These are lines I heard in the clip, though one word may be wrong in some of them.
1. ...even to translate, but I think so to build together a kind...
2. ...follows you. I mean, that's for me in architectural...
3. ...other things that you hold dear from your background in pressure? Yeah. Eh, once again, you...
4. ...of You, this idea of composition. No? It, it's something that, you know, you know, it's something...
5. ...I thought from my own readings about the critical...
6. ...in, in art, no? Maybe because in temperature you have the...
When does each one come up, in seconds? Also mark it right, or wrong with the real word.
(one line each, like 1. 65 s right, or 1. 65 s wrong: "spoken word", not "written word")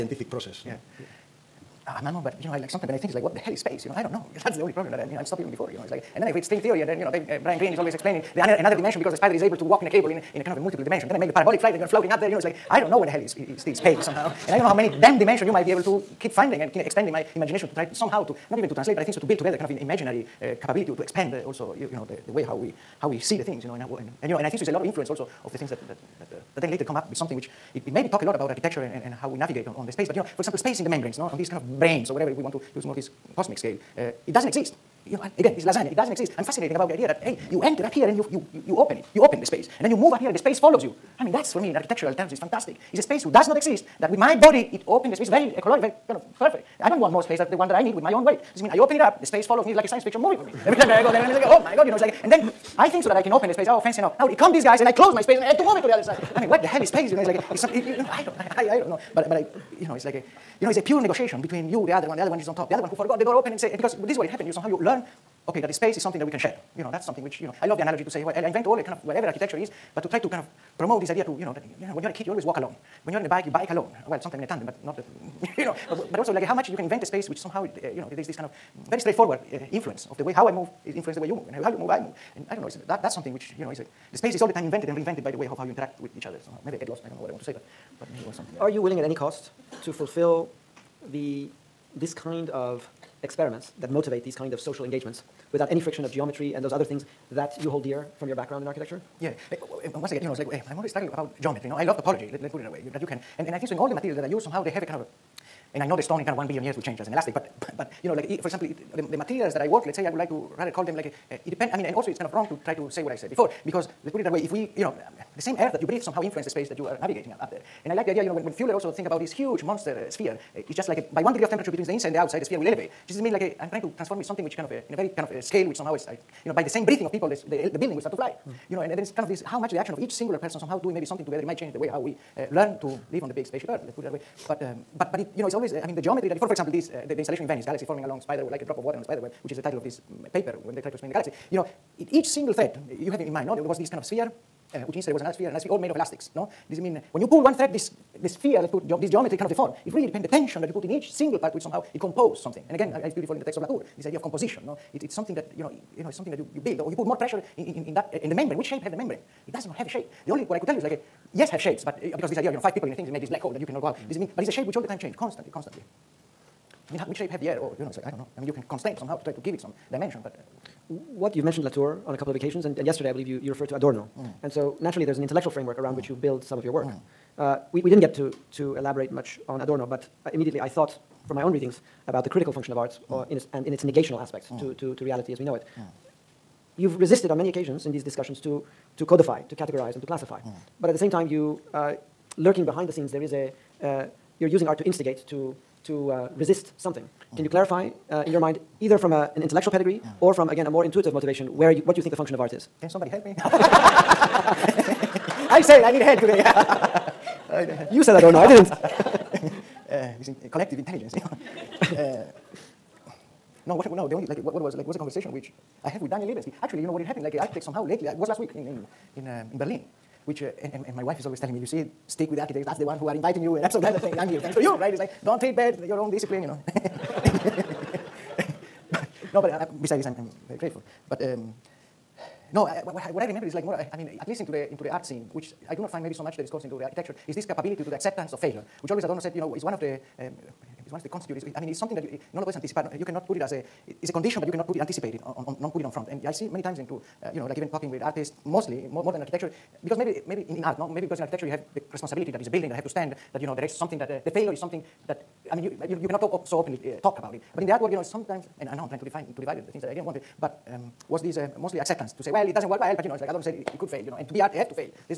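1. 18 s right
2. 40 s right
3. 96 s wrong: "architecture", not "pressure"
4. 153 s wrong: "Latour", not "You"
5. 180 s right
6. 250 s wrong: "architecture", not "temperature".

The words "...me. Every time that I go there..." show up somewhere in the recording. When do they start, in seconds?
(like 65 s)
50 s.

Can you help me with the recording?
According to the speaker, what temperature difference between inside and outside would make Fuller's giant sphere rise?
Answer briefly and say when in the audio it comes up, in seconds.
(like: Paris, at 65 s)
1 degree, at 121 s.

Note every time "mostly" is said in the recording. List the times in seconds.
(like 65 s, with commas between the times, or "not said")
248 s, 261 s.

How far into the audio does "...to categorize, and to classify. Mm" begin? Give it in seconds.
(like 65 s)
189 s.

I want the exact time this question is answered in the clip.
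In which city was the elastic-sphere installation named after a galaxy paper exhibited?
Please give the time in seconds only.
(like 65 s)
137 s.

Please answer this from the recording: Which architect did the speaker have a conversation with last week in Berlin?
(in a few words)
Daniel Libeskind.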